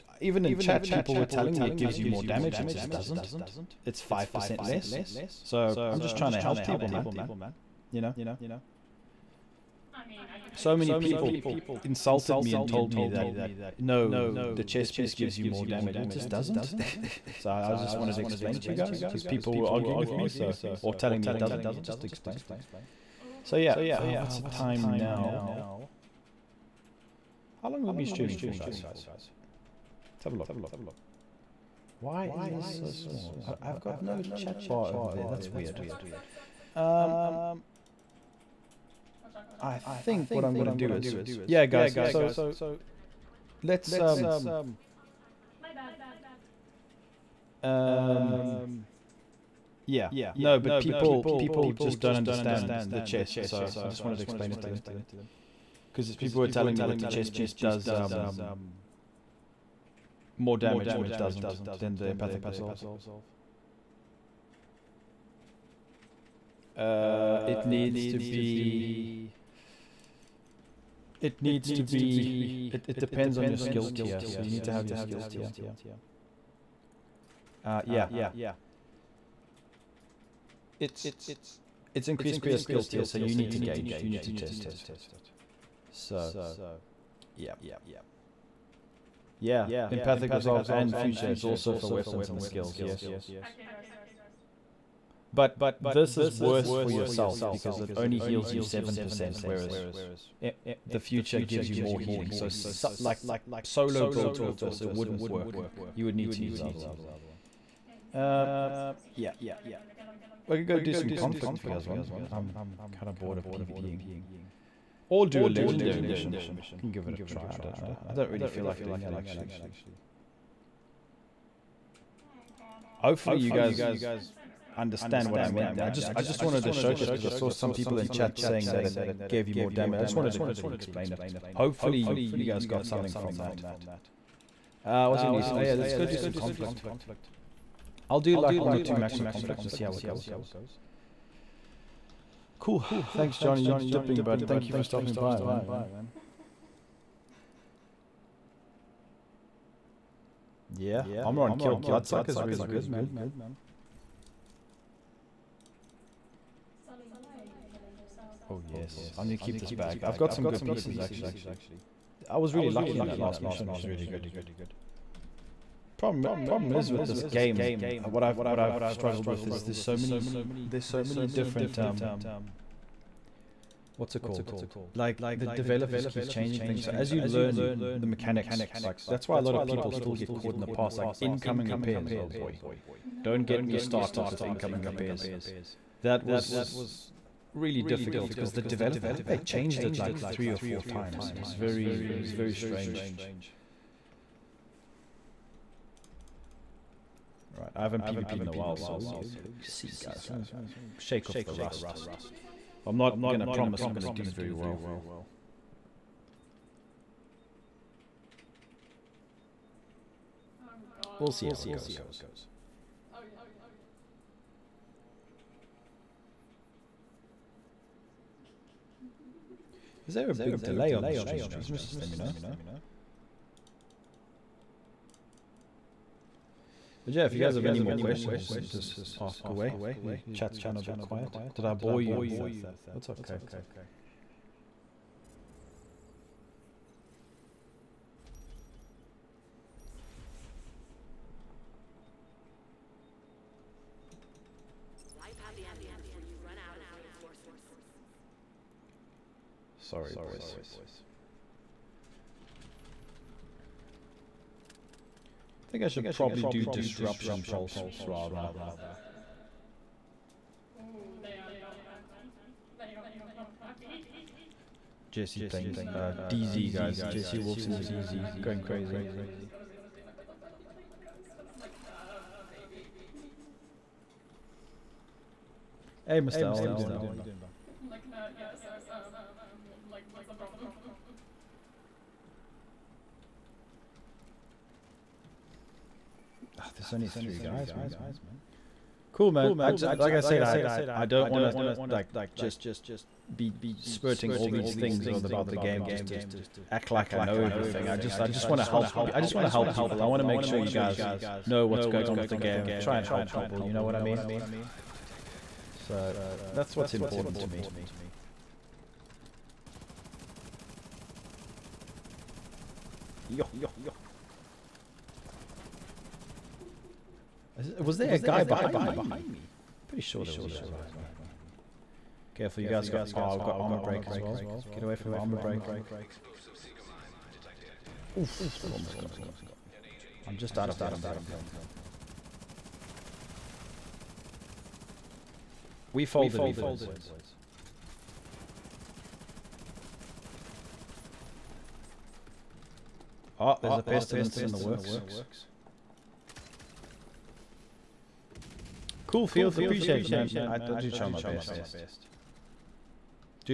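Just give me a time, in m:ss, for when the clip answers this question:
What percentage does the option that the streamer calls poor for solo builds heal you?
1:38.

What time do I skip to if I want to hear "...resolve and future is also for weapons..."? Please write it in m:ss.
1:30.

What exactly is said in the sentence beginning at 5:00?
I want to make sure you guys know what's going on with the game.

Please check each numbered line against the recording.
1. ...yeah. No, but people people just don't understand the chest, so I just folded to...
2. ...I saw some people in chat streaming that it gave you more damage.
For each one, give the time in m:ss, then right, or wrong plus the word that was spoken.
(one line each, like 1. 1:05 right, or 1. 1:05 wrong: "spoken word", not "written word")
1. 0:49 wrong: "wanted", not "folded"
2. 2:07 wrong: "saying", not "streaming".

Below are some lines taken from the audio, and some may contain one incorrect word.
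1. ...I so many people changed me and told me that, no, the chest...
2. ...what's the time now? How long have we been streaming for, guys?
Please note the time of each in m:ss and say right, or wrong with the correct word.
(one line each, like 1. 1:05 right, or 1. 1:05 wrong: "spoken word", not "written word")
1. 0:10 wrong: "insulted", not "changed"
2. 0:24 right.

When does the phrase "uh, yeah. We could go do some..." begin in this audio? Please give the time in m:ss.
1:48.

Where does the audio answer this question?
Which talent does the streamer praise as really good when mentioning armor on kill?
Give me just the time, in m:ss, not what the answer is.
2:31.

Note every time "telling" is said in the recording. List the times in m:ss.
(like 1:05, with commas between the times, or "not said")
0:01, 0:20, 0:56.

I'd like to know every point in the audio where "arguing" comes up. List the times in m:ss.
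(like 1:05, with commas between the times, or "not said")
0:19.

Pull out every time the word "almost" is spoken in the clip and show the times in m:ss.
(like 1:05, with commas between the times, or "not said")
5:28.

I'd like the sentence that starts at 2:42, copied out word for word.
I was really lucky in that last mission.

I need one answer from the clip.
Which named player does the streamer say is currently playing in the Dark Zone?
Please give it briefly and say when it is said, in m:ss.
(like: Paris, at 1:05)
JC Wolf, at 4:27.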